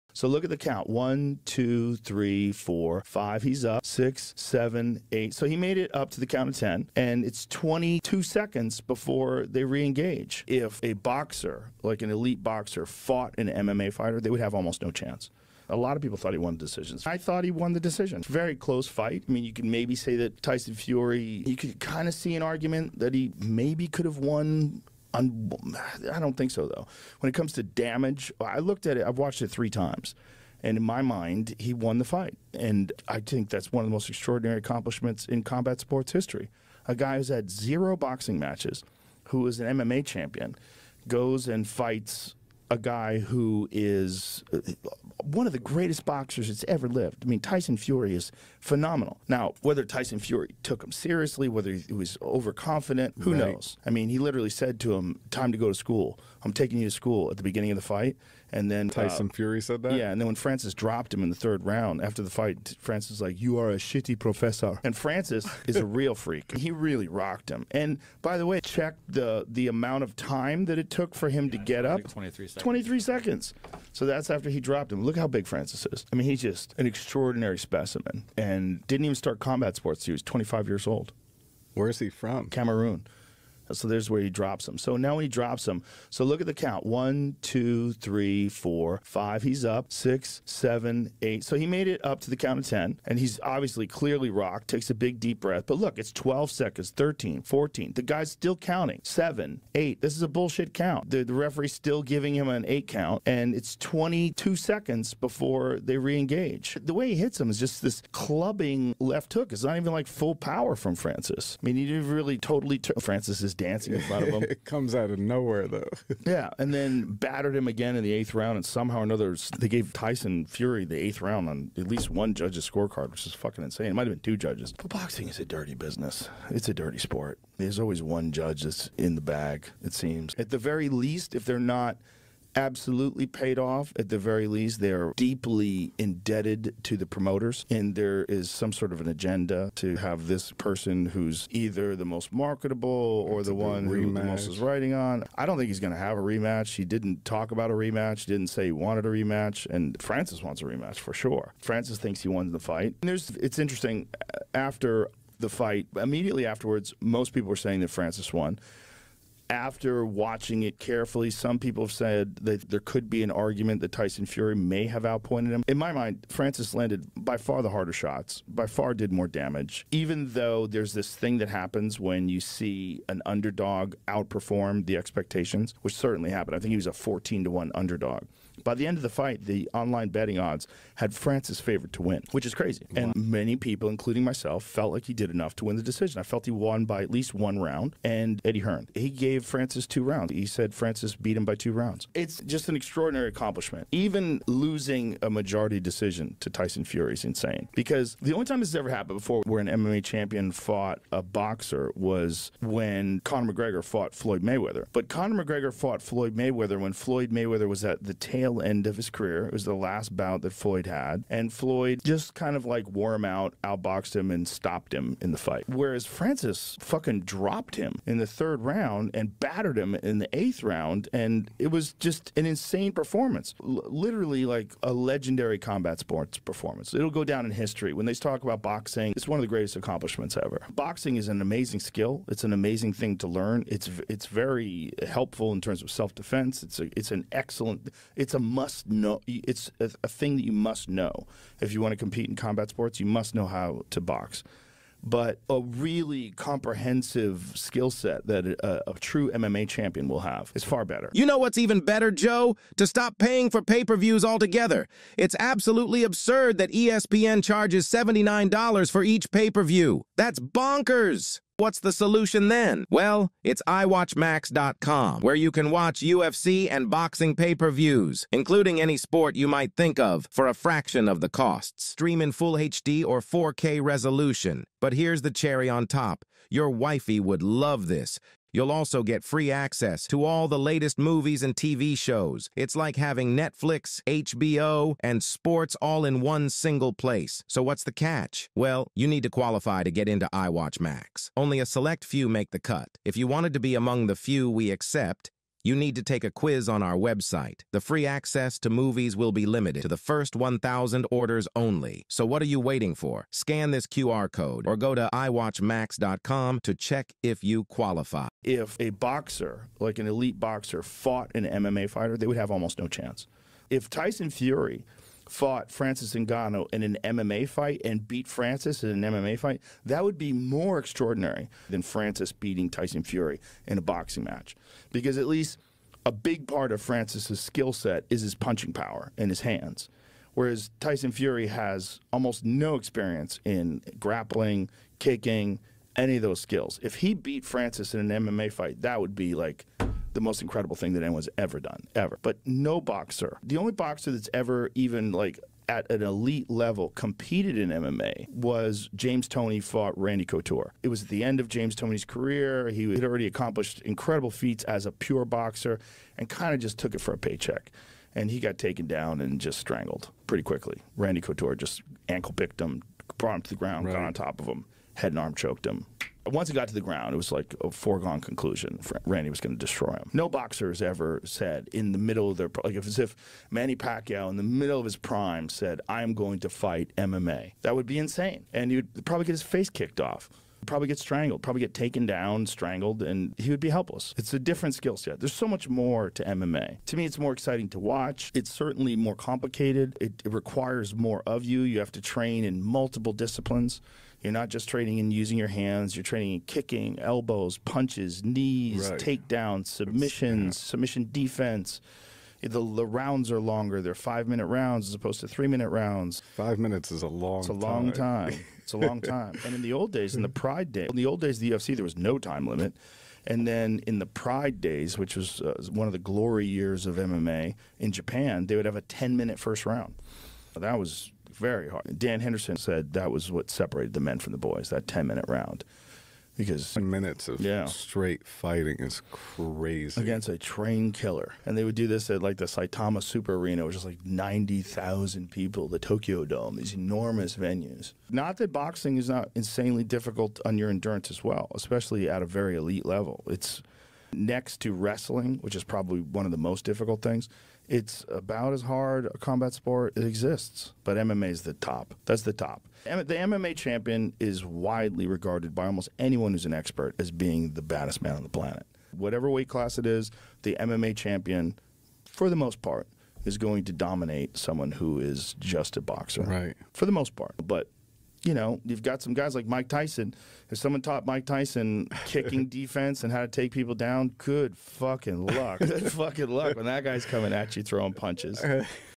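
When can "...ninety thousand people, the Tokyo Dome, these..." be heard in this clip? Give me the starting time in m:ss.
7:14.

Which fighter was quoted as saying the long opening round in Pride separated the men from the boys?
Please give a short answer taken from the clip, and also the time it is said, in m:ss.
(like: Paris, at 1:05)
Dan Henderson, at 7:01.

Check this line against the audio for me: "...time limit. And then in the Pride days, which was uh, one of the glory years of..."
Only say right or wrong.
right.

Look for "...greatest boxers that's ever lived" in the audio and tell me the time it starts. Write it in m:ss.
0:45.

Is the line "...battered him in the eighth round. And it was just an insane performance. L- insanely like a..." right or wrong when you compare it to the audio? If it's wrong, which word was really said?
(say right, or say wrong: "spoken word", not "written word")
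wrong: "literally", not "insanely".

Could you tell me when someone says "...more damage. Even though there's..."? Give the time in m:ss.
2:49.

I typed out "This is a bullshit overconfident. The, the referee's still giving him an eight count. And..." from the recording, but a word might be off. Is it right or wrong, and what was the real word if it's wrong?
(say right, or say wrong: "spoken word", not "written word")
wrong: "count", not "overconfident".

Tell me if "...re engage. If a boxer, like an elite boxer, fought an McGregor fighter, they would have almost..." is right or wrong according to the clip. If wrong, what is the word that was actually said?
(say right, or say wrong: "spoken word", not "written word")
wrong: "MMA", not "McGregor".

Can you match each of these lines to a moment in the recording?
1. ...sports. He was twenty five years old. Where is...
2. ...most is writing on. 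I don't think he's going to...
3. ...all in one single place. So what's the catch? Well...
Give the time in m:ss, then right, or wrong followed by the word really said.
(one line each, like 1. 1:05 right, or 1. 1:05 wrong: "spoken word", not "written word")
1. 1:19 right
2. 2:24 right
3. 4:45 right.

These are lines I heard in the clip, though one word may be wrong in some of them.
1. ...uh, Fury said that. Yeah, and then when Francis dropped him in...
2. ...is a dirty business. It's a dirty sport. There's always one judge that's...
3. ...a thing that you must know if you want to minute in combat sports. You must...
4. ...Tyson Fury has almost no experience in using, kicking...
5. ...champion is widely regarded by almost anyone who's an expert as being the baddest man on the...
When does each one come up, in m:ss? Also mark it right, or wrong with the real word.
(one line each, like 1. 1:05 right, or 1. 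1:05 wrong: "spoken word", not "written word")
1. 0:59 right
2. 2:05 right
3. 4:00 wrong: "compete", not "minute"
4. 5:30 wrong: "grappling", not "using"
5. 7:33 right.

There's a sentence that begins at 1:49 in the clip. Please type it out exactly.
It's not even like full power from Francis.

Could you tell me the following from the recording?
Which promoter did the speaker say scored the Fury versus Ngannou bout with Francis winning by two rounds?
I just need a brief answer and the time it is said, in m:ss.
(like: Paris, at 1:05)
Eddie Hearn, at 3:08.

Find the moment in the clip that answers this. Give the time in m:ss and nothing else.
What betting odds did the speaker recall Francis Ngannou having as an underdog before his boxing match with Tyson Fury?
2:56.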